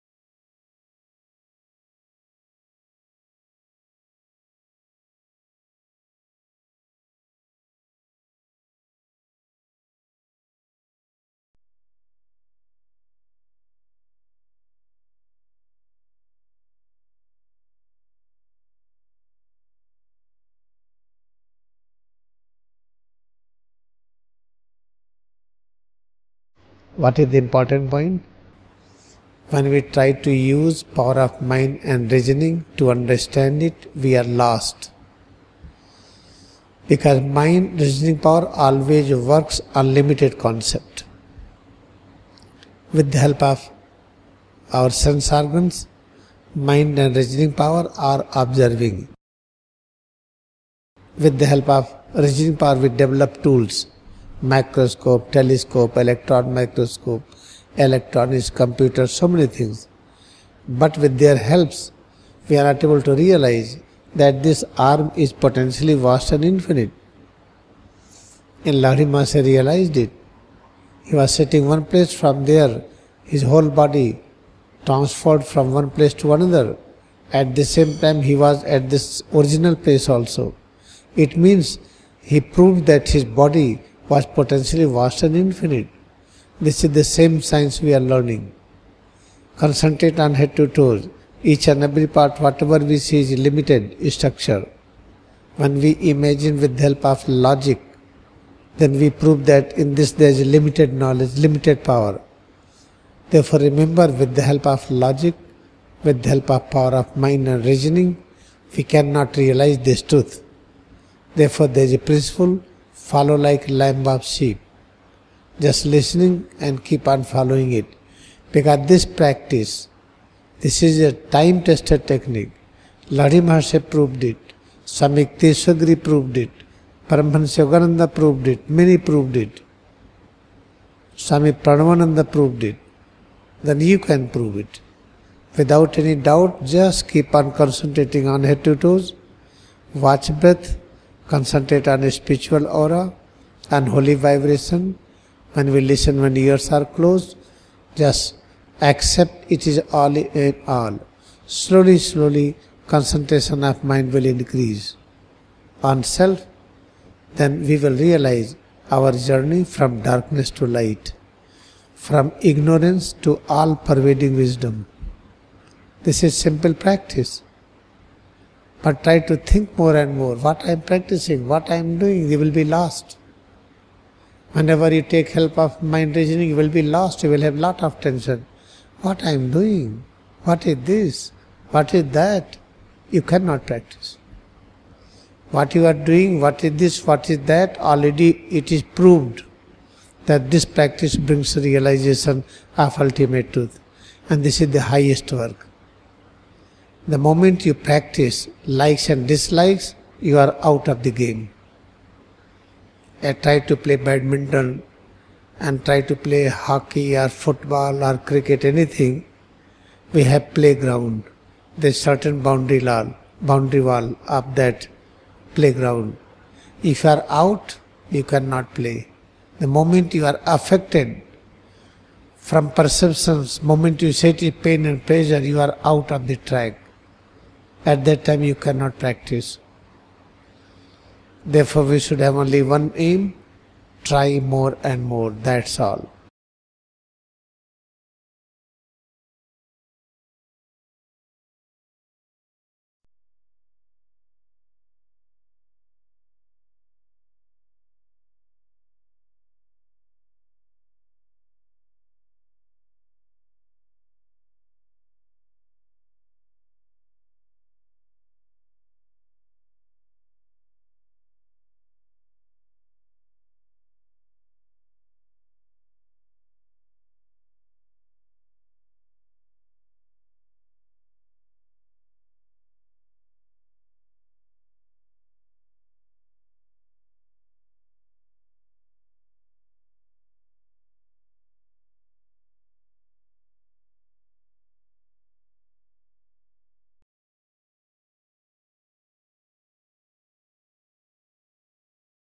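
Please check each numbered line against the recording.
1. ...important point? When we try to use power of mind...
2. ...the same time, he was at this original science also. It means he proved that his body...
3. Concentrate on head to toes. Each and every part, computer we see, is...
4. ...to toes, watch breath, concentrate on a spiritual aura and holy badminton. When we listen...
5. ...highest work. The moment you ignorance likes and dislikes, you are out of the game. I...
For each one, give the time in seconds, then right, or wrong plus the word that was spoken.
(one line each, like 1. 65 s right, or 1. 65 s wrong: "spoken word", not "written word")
1. 27 s right
2. 77 s wrong: "place", not "science"
3. 89 s wrong: "whatever", not "computer"
4. 138 s wrong: "vibration", not "badminton"
5. 194 s wrong: "practice", not "ignorance".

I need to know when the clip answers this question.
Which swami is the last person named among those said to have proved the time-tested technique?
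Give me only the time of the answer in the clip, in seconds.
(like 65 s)
131 s.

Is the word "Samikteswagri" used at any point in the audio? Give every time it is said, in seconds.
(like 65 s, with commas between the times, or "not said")
124 s.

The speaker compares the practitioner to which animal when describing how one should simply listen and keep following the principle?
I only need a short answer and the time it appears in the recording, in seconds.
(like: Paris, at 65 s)
sheep, at 114 s.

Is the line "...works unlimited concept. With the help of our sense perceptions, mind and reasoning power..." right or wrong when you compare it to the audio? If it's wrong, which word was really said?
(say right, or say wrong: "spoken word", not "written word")
wrong: "organs", not "perceptions".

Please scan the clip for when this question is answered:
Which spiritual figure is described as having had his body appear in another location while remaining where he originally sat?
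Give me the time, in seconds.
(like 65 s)
68 s.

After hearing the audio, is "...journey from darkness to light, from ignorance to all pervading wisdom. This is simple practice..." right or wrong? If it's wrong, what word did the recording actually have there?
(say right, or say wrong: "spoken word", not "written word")
right.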